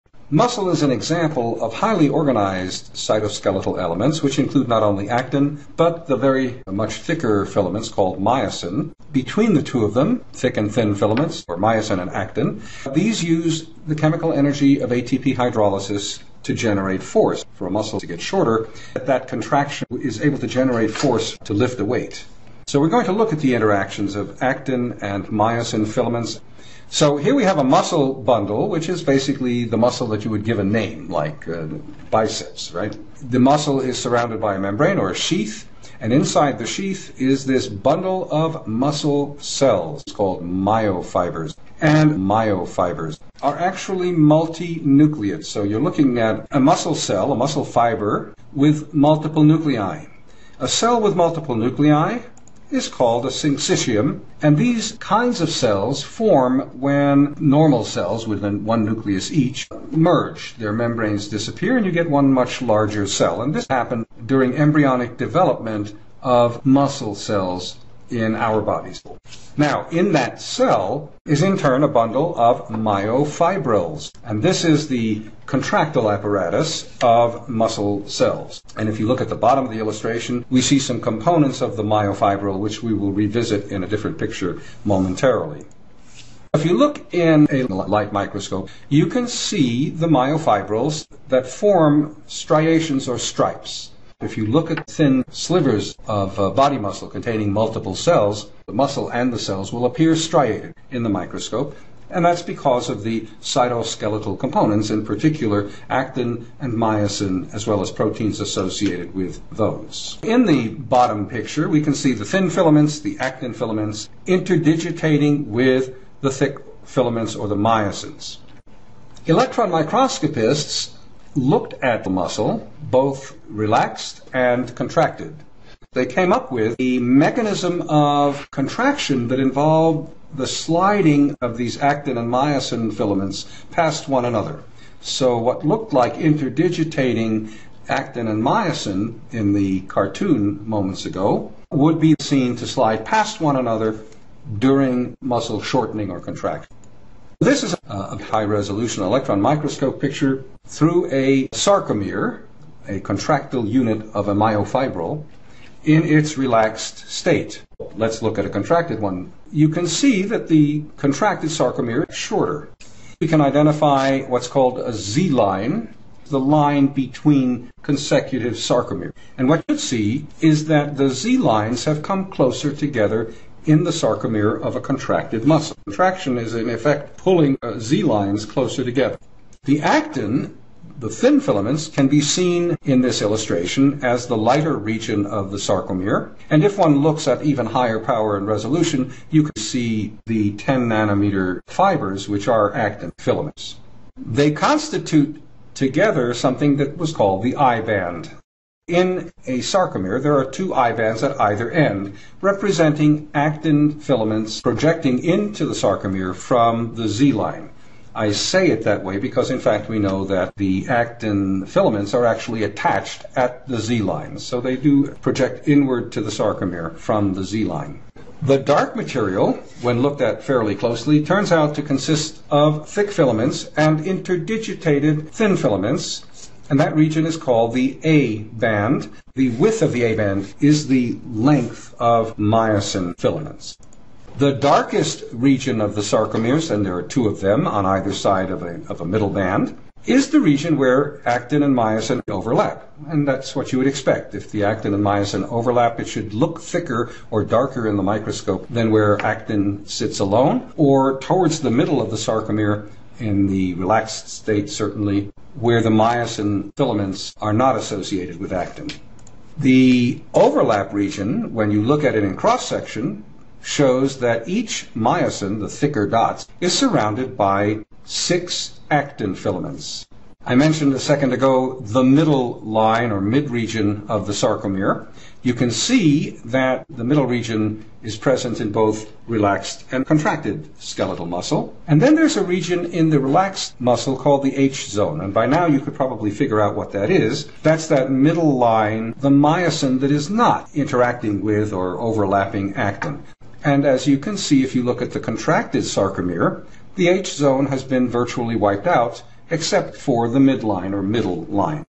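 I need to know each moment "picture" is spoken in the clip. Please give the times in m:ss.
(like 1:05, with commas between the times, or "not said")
1:24, 1:51, 2:29.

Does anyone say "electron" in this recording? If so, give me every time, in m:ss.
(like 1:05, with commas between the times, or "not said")
1:59, 2:29.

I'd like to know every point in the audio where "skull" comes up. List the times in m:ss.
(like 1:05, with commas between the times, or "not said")
not said.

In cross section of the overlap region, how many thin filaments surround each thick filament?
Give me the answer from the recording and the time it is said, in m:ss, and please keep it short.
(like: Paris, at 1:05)
6, at 4:28.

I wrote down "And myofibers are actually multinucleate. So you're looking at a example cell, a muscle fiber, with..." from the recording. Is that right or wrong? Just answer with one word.
wrong.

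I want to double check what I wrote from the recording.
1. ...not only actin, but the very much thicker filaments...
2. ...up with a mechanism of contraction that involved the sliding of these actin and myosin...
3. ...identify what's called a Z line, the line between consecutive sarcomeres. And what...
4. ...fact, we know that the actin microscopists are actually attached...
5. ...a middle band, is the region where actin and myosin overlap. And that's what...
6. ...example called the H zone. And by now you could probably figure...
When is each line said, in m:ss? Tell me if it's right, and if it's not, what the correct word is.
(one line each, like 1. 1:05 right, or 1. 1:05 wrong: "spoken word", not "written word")
1. 0:04 right
2. 2:06 right
3. 2:43 right
4. 3:29 wrong: "filaments", not "microscopists"
5. 3:59 right
6. 4:43 wrong: "muscle", not "example".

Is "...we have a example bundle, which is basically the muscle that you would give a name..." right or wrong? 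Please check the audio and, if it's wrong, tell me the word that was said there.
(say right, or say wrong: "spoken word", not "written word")
wrong: "muscle", not "example".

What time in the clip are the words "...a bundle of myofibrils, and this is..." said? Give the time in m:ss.
1:11.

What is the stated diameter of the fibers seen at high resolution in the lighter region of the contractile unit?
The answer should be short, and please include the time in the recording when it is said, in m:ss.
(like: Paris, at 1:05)
10 nanometers, at 3:10.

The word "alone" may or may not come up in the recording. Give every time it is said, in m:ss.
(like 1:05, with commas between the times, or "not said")
4:10.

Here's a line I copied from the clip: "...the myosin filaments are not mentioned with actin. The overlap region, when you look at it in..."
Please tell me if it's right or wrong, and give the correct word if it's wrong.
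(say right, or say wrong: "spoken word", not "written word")
wrong: "associated", not "mentioned".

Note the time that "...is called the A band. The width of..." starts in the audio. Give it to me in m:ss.
3:47.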